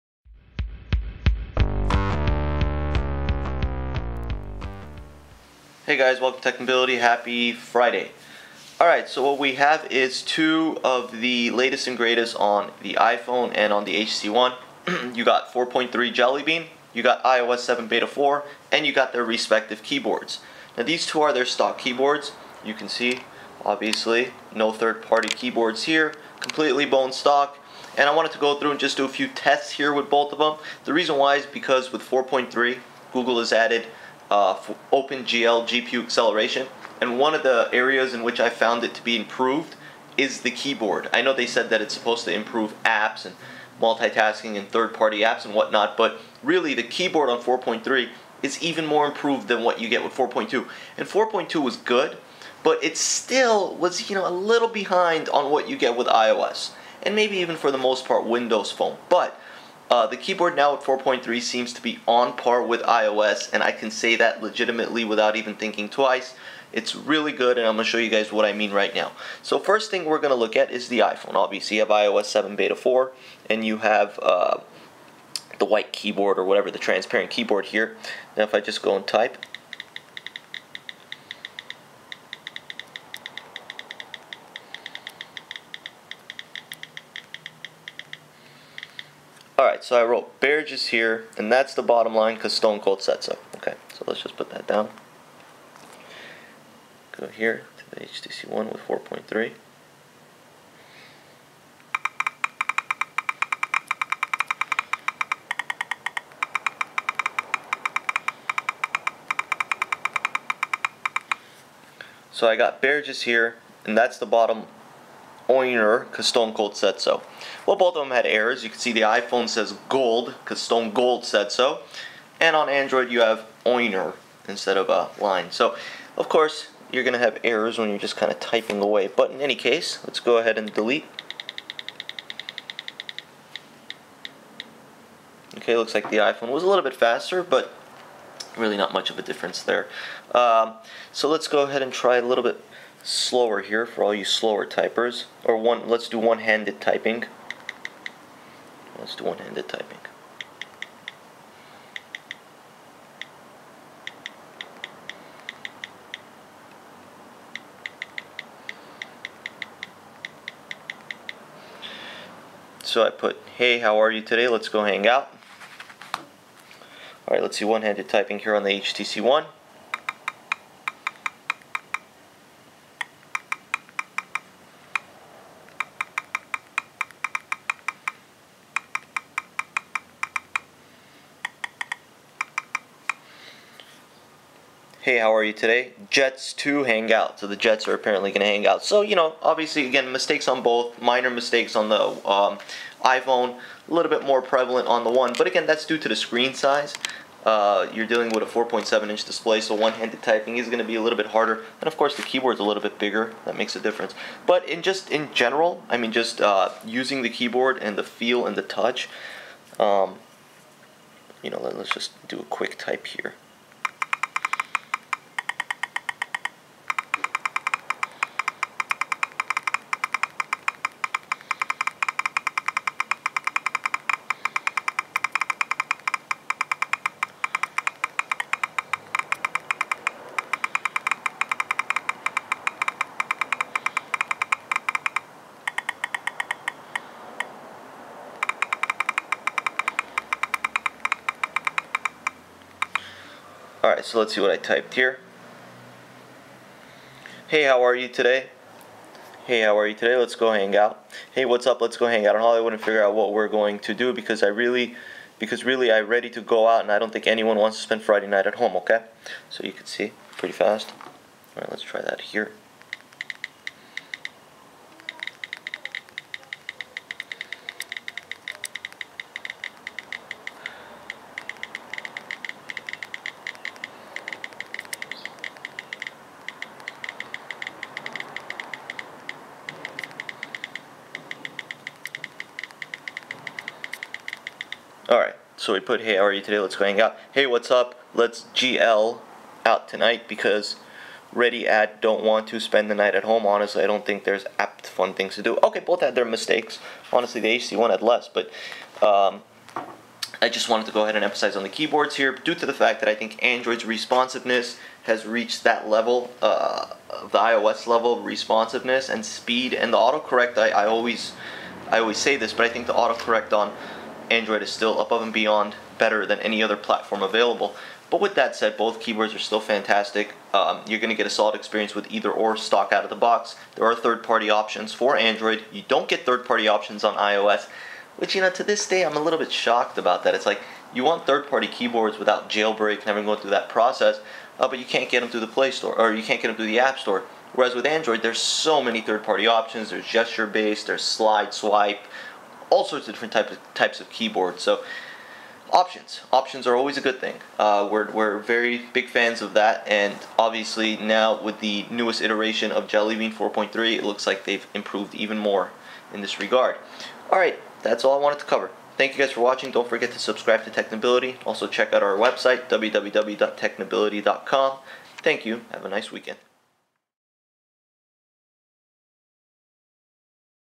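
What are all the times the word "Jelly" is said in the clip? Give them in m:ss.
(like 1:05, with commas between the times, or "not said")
0:16, 5:52.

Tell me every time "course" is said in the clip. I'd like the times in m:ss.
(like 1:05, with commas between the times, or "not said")
2:06, 3:21.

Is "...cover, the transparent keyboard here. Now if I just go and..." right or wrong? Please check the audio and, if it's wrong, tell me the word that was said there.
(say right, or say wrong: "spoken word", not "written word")
wrong: "whatever", not "cover".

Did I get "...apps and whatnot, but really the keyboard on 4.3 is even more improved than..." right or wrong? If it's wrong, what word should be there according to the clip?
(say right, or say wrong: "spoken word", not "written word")
right.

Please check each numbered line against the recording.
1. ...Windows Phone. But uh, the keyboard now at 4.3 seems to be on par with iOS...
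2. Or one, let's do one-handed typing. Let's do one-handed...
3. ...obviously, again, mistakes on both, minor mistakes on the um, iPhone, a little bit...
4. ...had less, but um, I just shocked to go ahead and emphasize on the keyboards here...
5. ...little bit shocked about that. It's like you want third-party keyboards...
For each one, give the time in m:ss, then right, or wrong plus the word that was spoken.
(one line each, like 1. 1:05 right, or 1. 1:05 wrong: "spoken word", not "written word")
1. 0:58 right
2. 2:25 right
3. 3:09 right
4. 4:57 wrong: "wanted", not "shocked"
5. 5:29 right.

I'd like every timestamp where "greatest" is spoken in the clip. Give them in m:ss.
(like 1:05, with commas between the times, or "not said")
0:11.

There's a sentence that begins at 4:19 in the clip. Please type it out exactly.
So you can see pretty fast.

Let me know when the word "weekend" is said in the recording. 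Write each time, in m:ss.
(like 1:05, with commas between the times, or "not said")
6:06.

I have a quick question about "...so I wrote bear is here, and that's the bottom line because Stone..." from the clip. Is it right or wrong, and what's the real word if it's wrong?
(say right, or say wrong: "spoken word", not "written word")
right.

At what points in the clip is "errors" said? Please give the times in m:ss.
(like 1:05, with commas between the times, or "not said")
1:58, 2:07.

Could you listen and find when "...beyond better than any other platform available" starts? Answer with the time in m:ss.
5:15.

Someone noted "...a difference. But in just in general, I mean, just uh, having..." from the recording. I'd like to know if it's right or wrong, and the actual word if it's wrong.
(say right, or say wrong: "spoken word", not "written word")
wrong: "using", not "having".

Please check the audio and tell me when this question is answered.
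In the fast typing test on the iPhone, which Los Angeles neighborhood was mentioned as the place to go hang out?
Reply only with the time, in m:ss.
4:12.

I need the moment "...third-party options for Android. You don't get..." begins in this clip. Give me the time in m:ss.
5:23.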